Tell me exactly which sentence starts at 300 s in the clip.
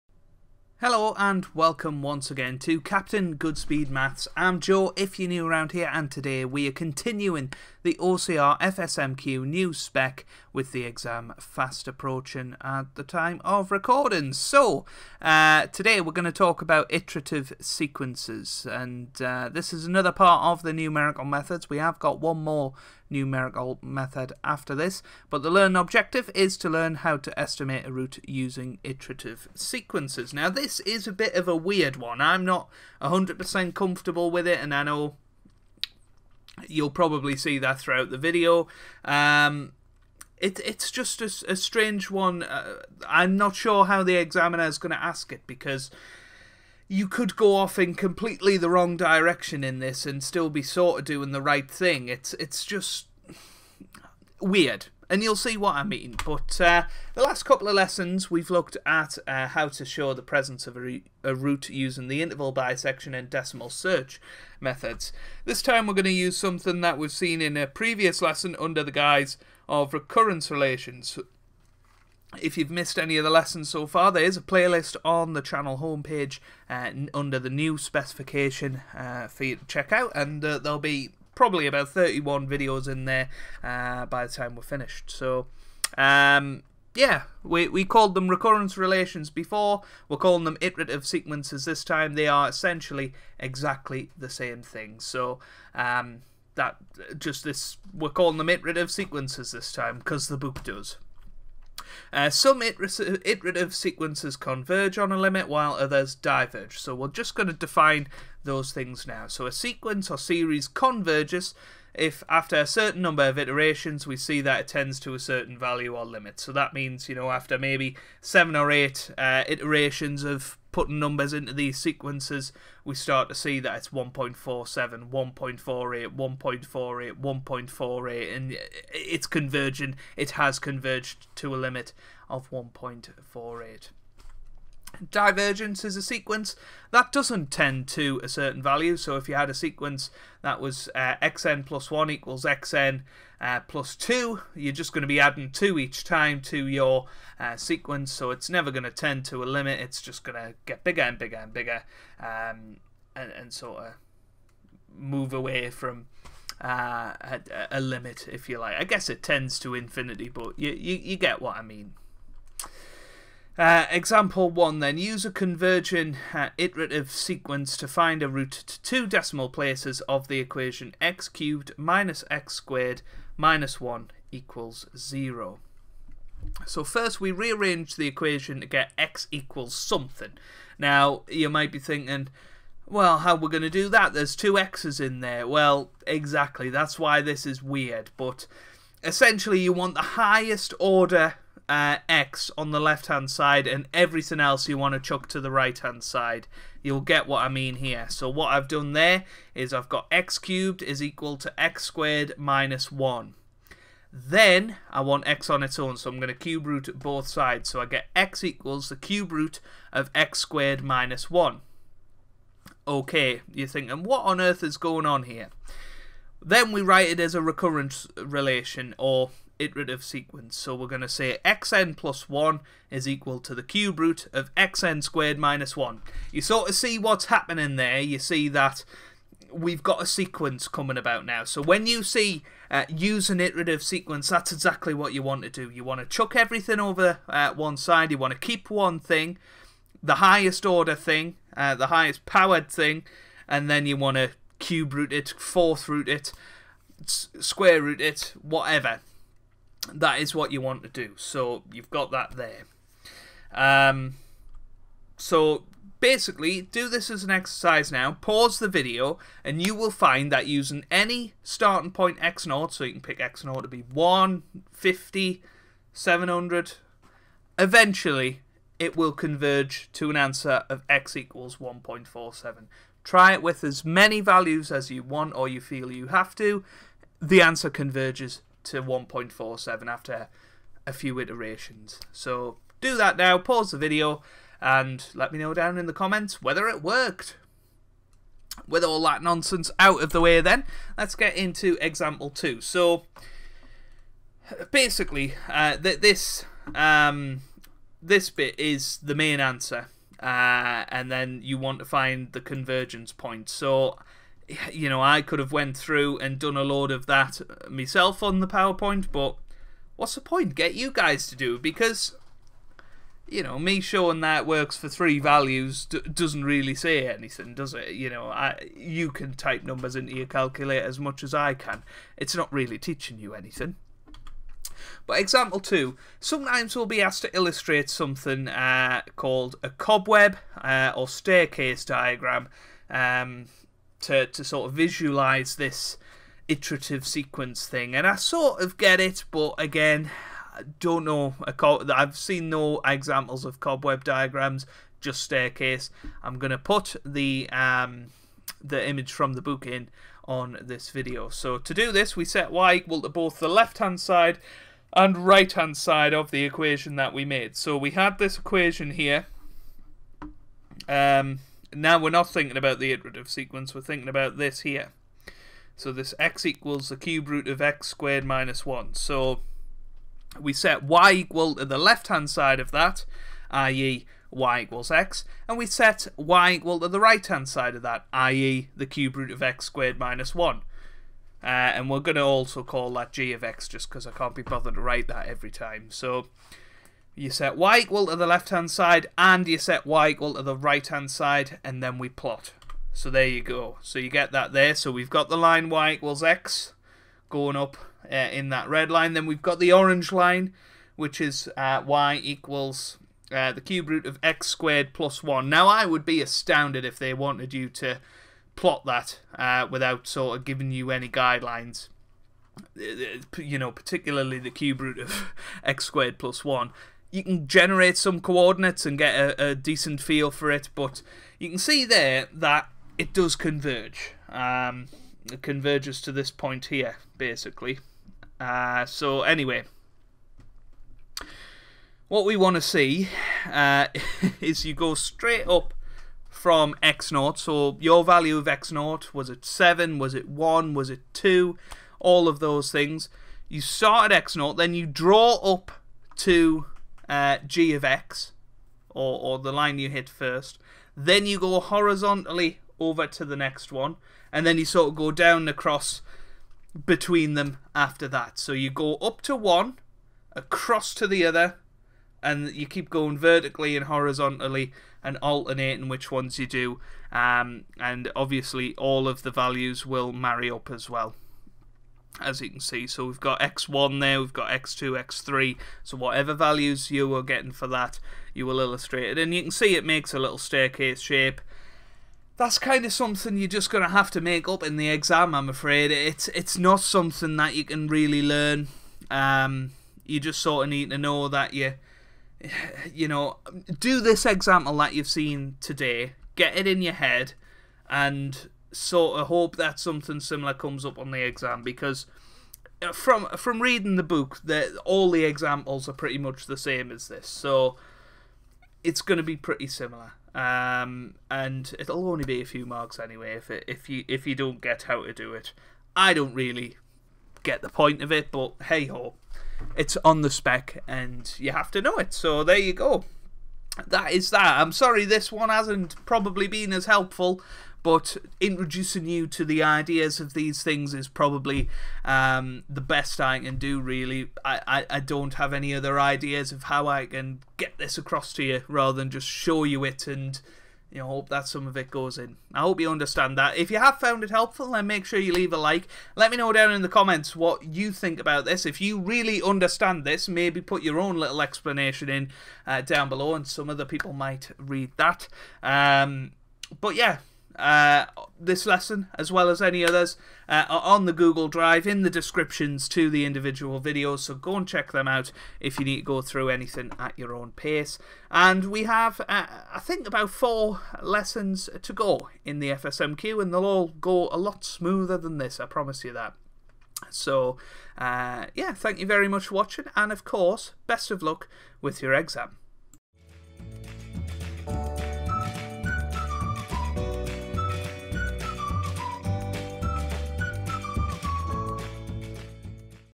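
Uh, and then you want to find the convergence point.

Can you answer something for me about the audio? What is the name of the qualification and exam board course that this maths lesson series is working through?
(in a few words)
OCR FSMQ.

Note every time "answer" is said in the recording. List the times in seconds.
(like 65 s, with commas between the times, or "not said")
270 s, 277 s, 299 s.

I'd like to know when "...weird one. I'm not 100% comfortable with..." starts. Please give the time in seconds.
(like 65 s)
31 s.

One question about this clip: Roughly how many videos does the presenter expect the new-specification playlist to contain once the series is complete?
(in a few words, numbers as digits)
31.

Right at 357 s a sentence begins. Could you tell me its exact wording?
So we had this equation here.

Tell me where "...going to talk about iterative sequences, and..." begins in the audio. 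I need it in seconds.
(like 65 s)
16 s.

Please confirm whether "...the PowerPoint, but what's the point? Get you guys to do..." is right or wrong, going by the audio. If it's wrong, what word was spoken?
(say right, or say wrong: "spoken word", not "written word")
right.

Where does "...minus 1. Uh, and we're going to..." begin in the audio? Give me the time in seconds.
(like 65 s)
379 s.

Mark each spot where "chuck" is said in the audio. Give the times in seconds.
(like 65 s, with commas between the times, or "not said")
194 s, 236 s.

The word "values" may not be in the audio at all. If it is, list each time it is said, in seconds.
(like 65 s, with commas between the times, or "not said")
115 s, 138 s, 274 s, 315 s, 438 s, 469 s, 476 s.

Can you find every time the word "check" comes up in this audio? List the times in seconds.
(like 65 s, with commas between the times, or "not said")
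79 s, 564 s.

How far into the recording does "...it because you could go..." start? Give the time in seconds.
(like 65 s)
45 s.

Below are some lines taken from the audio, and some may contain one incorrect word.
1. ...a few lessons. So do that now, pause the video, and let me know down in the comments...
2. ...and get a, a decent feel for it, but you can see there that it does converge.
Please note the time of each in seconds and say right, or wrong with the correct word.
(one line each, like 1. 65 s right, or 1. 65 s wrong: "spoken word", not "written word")
1. 280 s wrong: "iterations", not "lessons"
2. 418 s right.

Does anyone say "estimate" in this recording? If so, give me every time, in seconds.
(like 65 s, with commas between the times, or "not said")
27 s.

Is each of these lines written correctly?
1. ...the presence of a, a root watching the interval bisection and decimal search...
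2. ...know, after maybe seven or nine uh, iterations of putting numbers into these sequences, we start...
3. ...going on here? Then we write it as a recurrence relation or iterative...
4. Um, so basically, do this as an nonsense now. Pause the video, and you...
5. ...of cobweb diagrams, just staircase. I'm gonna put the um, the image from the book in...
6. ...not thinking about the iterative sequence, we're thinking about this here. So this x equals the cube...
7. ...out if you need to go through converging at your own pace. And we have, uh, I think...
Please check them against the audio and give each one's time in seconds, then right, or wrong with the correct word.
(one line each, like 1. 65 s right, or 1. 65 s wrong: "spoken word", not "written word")
1. 60 s wrong: "using", not "watching"
2. 117 s wrong: "eight", not "nine"
3. 214 s right
4. 253 s wrong: "exercise", not "nonsense"
5. 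343 s right
6. 362 s right
7. 565 s wrong: "anything", not "converging".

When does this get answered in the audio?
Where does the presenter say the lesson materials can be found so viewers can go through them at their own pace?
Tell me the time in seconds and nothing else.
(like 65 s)
561 s.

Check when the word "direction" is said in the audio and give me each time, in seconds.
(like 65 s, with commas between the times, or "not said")
48 s.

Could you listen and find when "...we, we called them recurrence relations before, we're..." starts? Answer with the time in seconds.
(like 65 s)
87 s.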